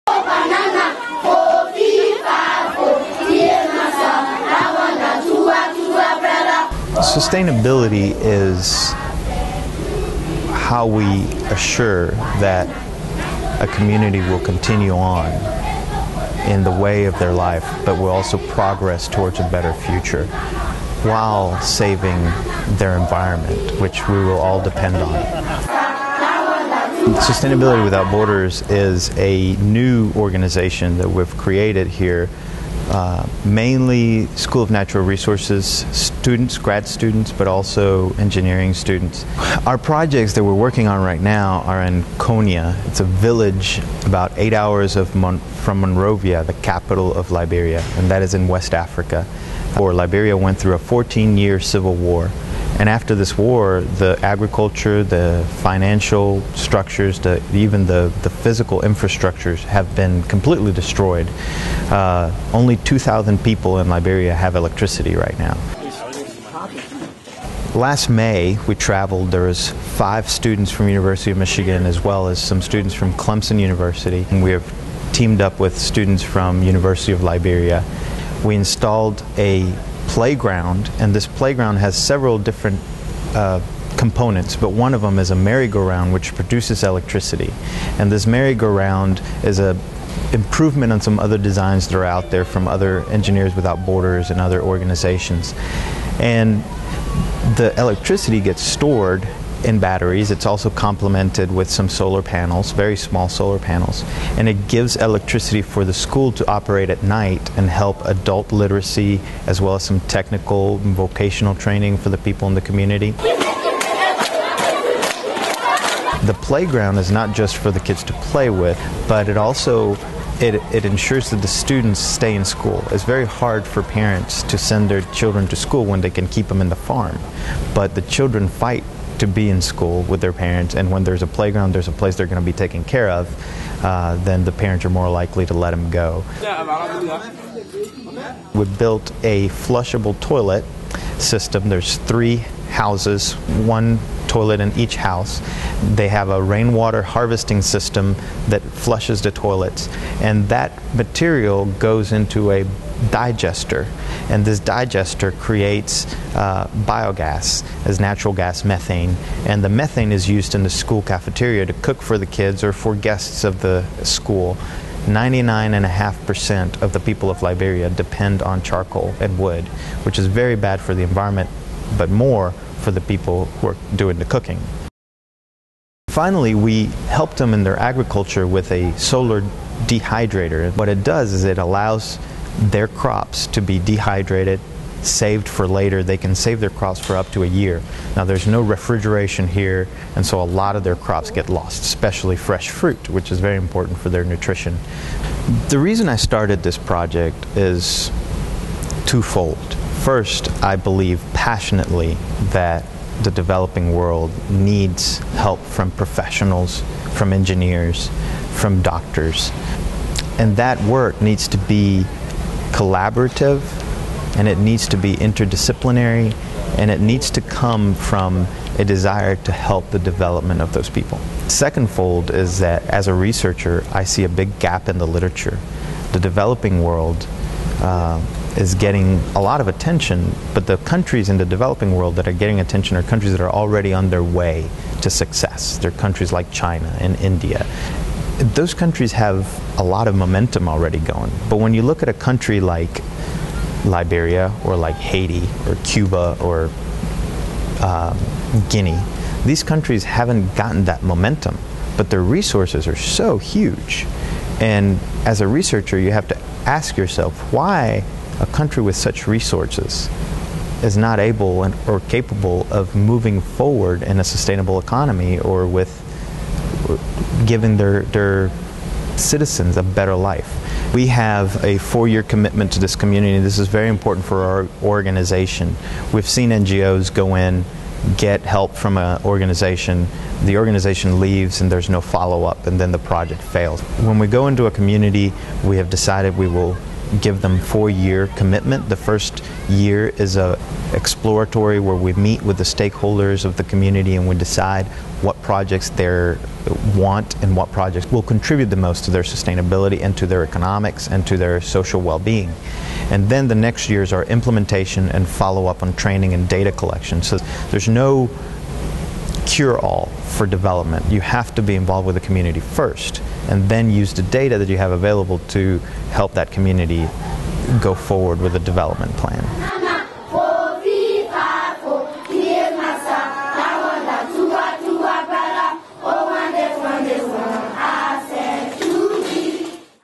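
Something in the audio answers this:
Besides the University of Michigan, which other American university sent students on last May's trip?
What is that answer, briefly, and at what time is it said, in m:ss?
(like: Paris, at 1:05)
Clemson University, at 1:13.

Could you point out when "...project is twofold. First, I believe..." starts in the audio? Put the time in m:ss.
3:16.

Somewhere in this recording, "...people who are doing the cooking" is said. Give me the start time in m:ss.
2:53.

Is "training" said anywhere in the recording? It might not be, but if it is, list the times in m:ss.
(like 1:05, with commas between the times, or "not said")
1:51, 5:05.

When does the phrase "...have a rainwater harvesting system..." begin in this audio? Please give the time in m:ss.
2:26.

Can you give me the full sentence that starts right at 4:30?
We have a four-year commitment to this community.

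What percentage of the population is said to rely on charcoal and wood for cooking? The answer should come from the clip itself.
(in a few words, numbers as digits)
99.5%.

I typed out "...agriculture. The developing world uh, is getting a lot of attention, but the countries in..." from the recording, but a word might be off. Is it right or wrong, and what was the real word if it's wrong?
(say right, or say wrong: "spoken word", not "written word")
wrong: "literature", not "agriculture".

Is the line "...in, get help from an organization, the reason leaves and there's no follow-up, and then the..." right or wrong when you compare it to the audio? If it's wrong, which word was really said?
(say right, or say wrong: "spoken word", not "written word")
wrong: "organization", not "reason".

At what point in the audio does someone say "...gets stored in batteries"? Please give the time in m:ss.
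1:38.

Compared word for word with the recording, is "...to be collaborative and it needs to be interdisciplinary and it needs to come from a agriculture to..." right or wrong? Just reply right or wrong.
wrong.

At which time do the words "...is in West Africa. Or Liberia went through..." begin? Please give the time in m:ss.
0:48.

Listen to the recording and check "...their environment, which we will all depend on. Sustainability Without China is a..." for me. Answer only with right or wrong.
wrong.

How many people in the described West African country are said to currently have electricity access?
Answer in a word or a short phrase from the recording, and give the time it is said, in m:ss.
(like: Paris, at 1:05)
2,000, at 1:02.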